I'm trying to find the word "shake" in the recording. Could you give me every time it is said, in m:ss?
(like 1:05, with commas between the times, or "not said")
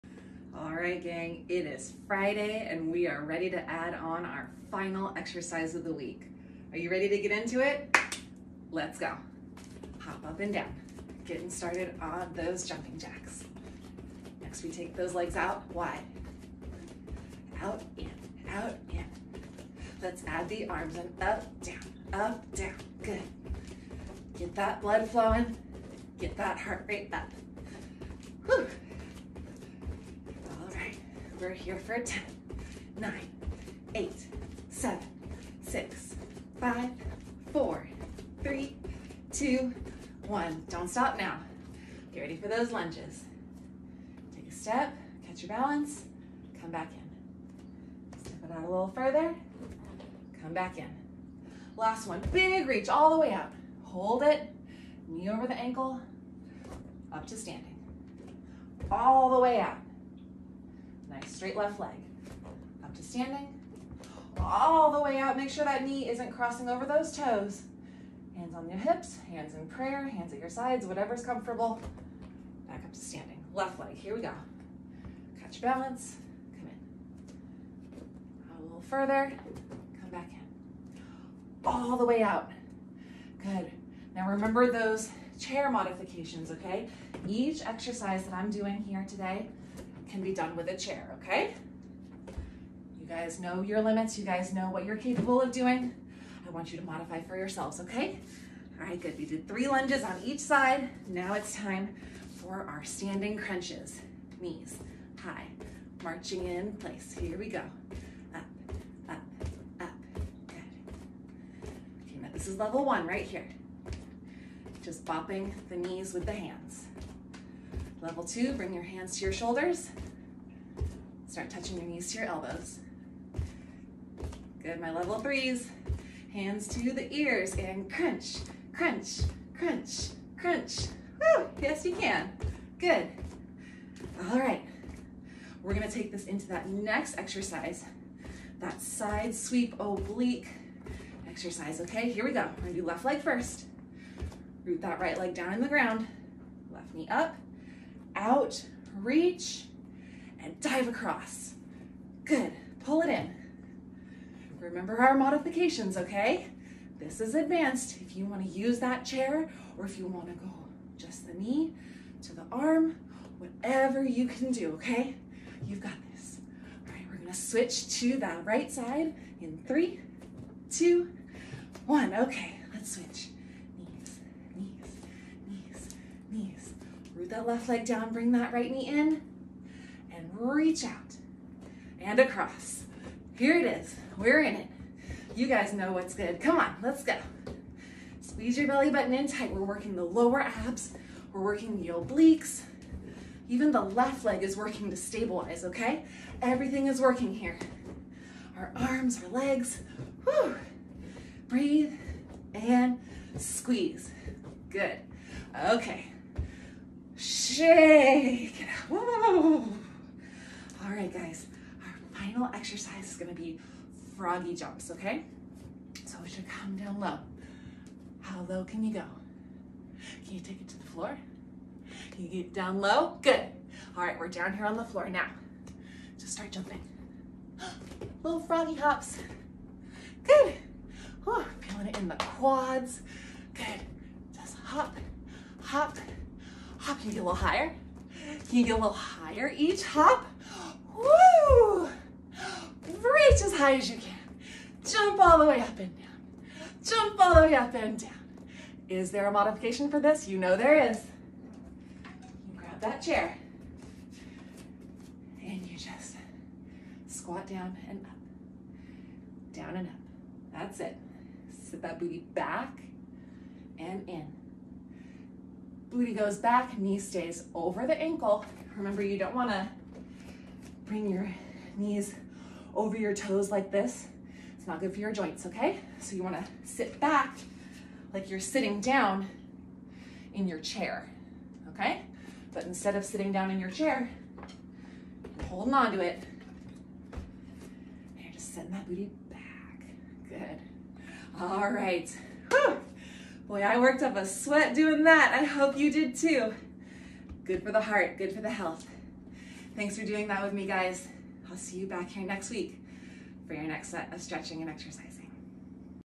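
3:27.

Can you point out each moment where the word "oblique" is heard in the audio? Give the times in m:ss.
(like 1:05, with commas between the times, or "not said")
2:19, 3:11.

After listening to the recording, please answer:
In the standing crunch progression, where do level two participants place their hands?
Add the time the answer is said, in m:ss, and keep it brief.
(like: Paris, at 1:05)
Shoulders, at 1:59.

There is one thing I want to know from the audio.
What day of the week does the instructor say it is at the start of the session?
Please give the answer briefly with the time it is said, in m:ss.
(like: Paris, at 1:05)
Friday, at 0:02.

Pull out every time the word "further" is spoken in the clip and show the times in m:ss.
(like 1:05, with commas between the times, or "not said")
0:48, 1:18.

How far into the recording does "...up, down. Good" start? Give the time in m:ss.
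0:22.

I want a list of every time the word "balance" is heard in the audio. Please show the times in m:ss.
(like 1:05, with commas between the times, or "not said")
0:45, 1:15.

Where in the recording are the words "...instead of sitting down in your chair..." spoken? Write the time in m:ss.
4:42.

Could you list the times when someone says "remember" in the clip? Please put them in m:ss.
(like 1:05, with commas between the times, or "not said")
1:24, 2:34, 4:28.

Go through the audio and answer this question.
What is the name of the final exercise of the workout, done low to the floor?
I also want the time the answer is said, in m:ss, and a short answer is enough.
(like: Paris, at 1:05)
Froggy jumps, at 3:34.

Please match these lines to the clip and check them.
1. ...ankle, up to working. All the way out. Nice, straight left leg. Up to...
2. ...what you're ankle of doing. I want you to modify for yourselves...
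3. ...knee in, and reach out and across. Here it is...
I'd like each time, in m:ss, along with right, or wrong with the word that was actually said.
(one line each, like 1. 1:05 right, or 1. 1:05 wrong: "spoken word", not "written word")
1. 0:55 wrong: "standing", not "working"
2. 1:34 wrong: "capable", not "ankle"
3. 2:58 right.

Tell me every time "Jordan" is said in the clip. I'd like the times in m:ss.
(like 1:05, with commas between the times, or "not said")
not said.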